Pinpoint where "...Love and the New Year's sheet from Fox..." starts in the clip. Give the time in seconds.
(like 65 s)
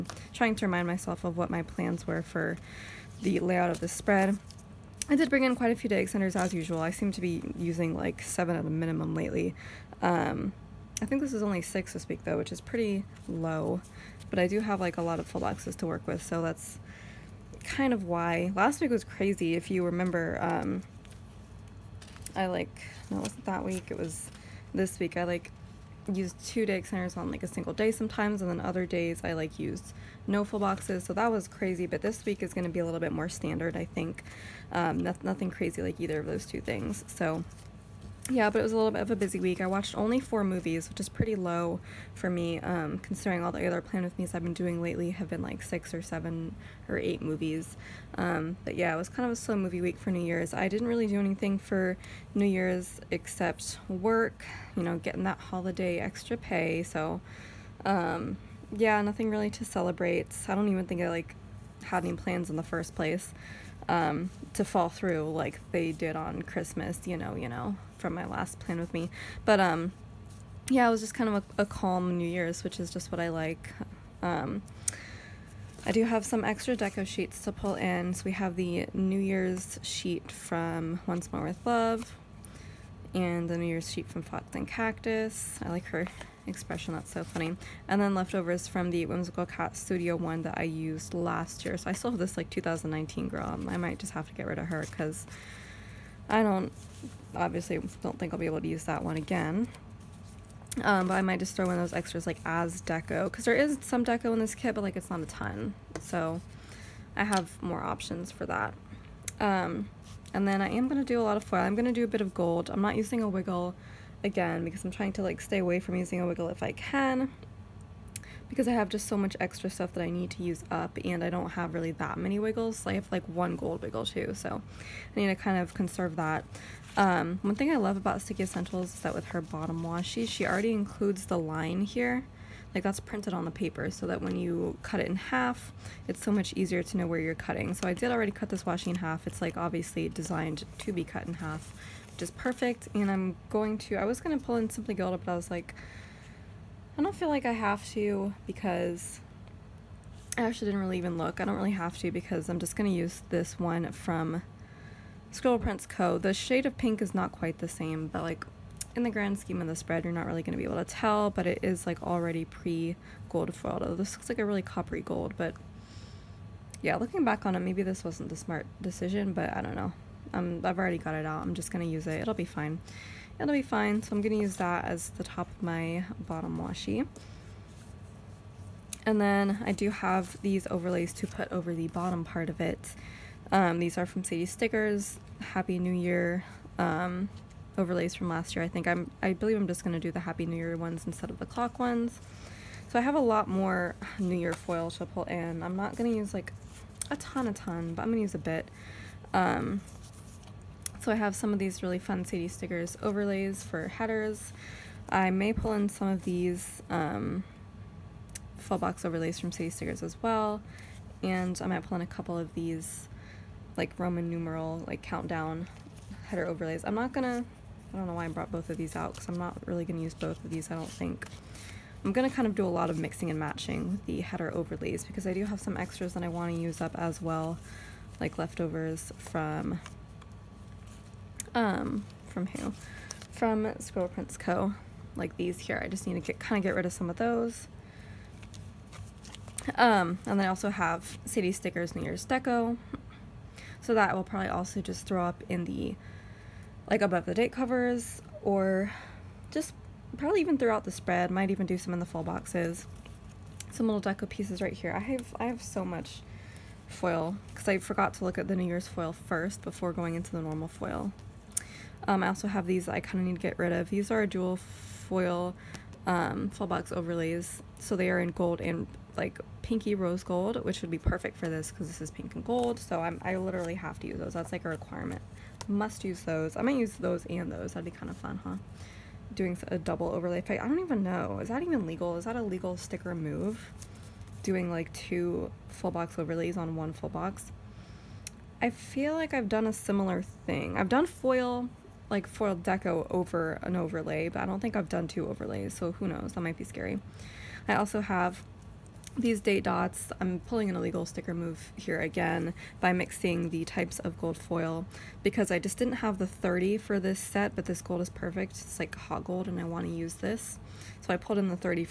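81 s.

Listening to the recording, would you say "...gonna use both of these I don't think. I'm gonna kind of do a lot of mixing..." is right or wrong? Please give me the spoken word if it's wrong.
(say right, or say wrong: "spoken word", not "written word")
right.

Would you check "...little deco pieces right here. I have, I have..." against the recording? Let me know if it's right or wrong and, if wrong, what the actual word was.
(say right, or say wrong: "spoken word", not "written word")
right.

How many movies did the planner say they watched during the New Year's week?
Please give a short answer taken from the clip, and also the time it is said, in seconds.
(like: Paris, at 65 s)
4, at 40 s.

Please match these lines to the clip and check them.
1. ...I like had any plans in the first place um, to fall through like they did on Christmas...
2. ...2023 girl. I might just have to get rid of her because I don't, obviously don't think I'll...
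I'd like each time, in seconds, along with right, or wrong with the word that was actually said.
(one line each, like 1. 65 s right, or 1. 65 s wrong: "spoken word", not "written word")
1. 61 s right
2. 92 s wrong: "2019", not "2023".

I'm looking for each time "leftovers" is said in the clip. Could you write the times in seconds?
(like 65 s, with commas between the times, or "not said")
88 s, 228 s.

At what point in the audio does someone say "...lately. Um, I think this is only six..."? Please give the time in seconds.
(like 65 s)
9 s.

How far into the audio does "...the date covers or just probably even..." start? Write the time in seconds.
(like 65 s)
247 s.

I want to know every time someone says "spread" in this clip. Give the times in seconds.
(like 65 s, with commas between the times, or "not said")
3 s, 159 s, 250 s.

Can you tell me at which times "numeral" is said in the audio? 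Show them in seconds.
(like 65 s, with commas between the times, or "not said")
214 s.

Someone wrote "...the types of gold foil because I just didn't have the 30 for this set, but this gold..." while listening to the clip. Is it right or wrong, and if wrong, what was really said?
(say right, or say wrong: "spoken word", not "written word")
right.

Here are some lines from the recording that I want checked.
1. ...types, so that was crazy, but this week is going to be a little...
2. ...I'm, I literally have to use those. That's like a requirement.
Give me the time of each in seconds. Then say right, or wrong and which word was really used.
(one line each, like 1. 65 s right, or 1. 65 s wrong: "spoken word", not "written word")
1. 30 s wrong: "boxes", not "types"
2. 273 s right.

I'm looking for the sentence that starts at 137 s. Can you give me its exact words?
So I did already cut this washi in half.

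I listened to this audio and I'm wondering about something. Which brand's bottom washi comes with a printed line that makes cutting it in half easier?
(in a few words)
Sticky Essentials.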